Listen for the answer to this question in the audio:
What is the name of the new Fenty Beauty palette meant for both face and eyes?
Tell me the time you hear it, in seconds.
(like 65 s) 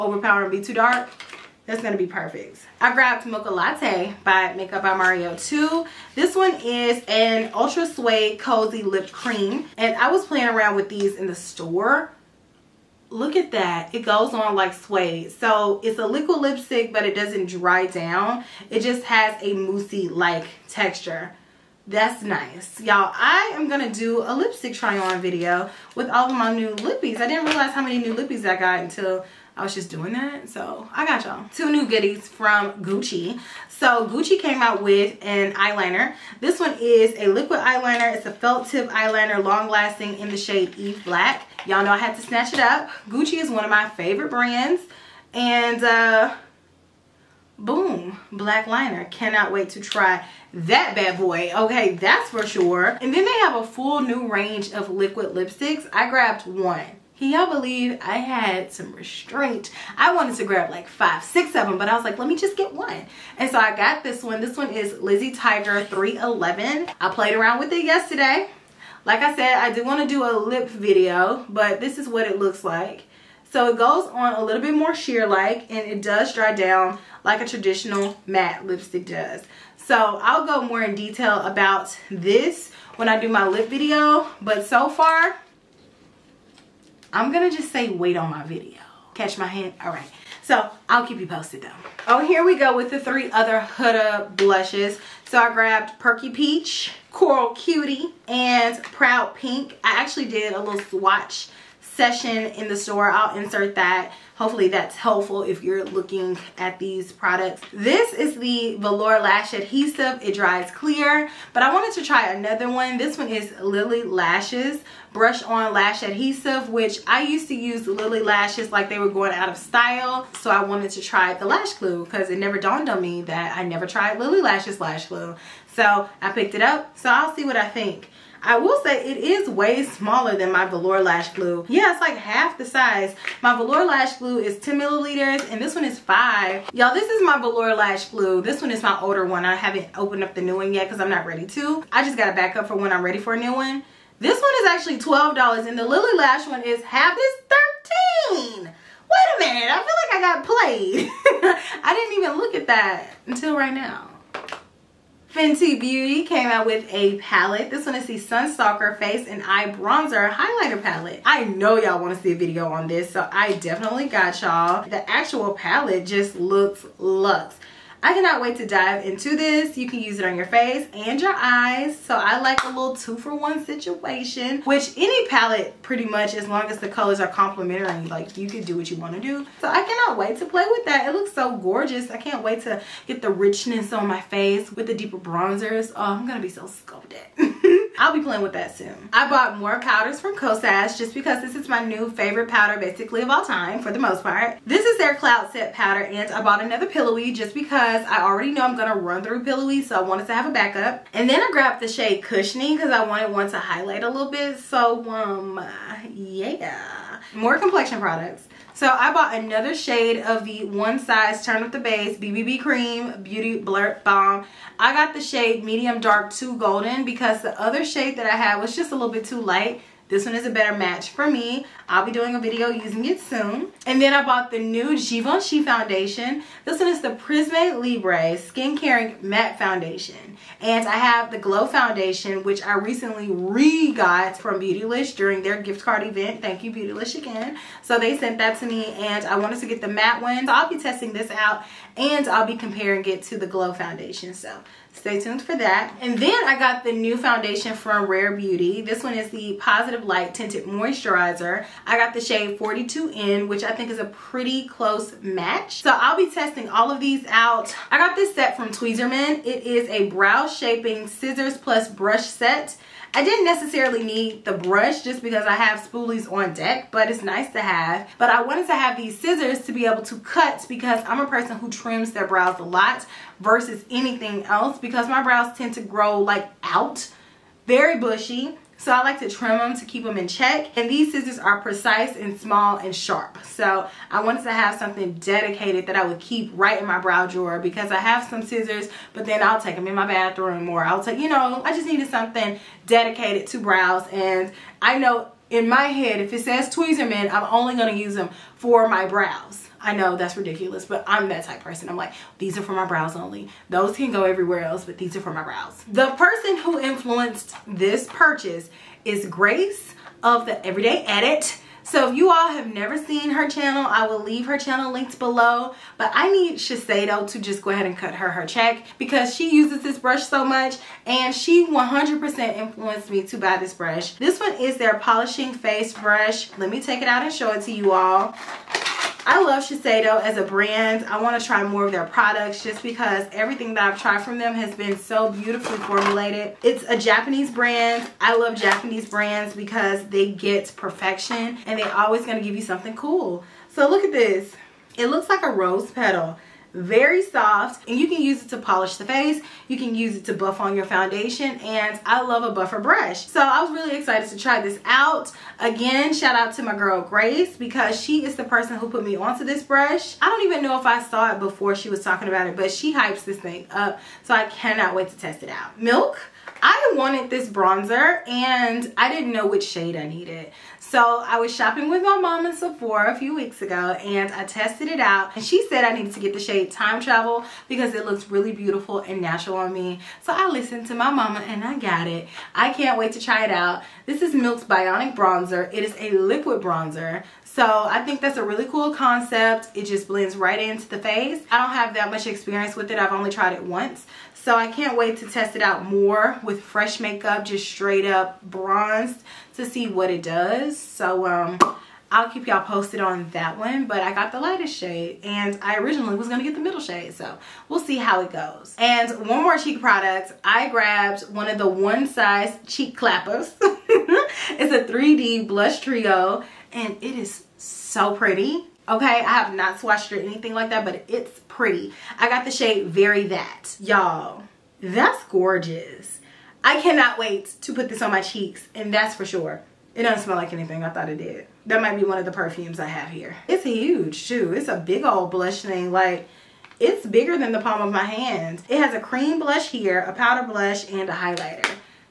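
158 s.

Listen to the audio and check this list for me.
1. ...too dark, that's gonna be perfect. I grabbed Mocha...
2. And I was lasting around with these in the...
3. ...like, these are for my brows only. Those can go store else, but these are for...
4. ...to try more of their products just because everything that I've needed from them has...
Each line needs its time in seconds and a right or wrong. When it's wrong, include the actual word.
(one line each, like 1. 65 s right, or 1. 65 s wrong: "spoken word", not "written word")
1. 0 s right
2. 9 s wrong: "playing", not "lasting"
3. 301 s wrong: "everywhere", not "store"
4. 331 s wrong: "tried", not "needed".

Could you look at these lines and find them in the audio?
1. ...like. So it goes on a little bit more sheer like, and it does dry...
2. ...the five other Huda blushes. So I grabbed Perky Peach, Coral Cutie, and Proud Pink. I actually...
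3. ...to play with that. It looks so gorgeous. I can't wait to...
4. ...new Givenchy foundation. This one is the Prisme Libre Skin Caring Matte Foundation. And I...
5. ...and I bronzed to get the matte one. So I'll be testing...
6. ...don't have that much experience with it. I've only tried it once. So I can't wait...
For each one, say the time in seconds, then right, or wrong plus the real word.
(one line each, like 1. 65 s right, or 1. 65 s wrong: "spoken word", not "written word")
1. 72 s right
2. 92 s wrong: "three", not "five"
3. 180 s right
4. 224 s right
5. 238 s wrong: "wanted", not "bronzed"
6. 391 s right.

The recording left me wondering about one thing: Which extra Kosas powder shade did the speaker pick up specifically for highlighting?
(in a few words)
Cushioning.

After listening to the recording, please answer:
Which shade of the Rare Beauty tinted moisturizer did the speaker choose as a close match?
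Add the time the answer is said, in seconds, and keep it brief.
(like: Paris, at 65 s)
42N, at 252 s.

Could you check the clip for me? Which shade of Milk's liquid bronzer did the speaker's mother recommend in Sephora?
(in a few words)
Time Travel.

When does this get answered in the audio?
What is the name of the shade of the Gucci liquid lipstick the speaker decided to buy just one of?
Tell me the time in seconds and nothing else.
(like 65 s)
65 s.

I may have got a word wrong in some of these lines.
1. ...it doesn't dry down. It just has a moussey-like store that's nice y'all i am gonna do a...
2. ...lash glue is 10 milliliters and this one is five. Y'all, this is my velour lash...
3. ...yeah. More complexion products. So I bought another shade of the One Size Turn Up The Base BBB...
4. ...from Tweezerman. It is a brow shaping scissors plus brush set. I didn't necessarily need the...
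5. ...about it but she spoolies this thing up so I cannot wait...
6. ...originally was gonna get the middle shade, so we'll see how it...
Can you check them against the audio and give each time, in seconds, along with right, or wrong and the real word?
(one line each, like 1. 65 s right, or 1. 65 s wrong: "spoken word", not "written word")
1. 17 s wrong: "texture", not "store"
2. 133 s right
3. 206 s right
4. 258 s right
5. 362 s wrong: "hypes", not "spoolies"
6. 405 s right.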